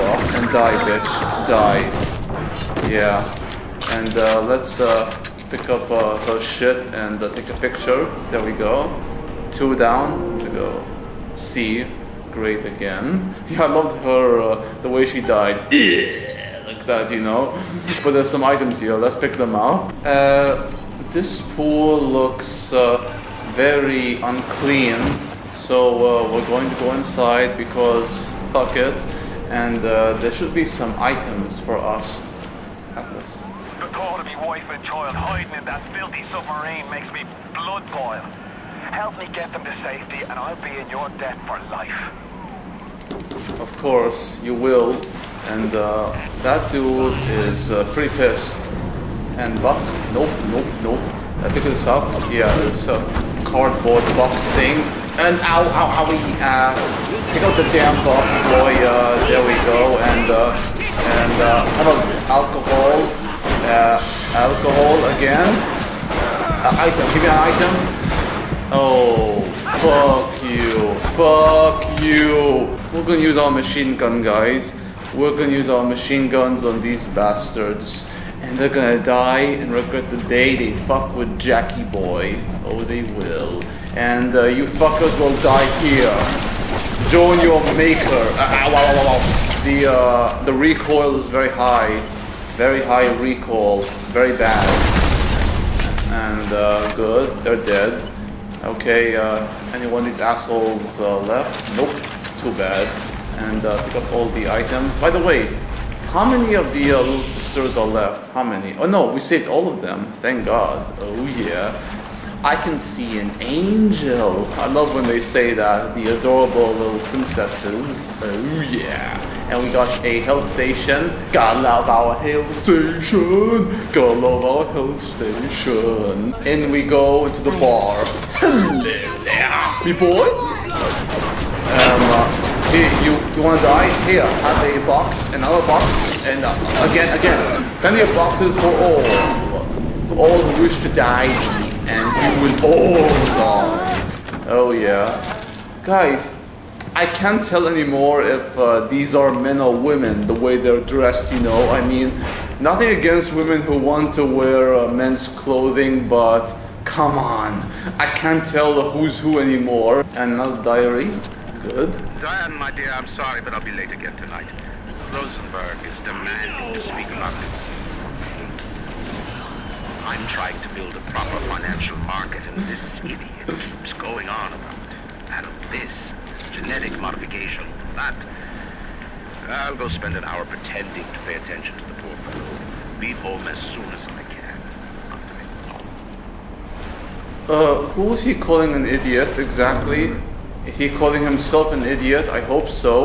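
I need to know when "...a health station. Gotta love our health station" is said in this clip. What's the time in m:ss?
2:00.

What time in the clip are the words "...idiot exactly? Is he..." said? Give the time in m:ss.
3:08.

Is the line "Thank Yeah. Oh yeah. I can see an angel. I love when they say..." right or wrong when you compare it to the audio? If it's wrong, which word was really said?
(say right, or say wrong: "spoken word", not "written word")
wrong: "God", not "Yeah".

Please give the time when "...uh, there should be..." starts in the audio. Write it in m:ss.
0:29.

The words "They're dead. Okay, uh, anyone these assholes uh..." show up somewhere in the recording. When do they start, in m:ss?
1:37.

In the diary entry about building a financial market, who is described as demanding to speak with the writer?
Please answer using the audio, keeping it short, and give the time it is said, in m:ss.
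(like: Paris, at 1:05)
Rosenberg, at 2:45.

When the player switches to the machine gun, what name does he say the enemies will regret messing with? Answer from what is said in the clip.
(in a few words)
Jackie Boy.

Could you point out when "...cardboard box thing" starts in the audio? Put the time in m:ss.
0:53.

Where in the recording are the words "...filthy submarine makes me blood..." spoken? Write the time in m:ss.
0:35.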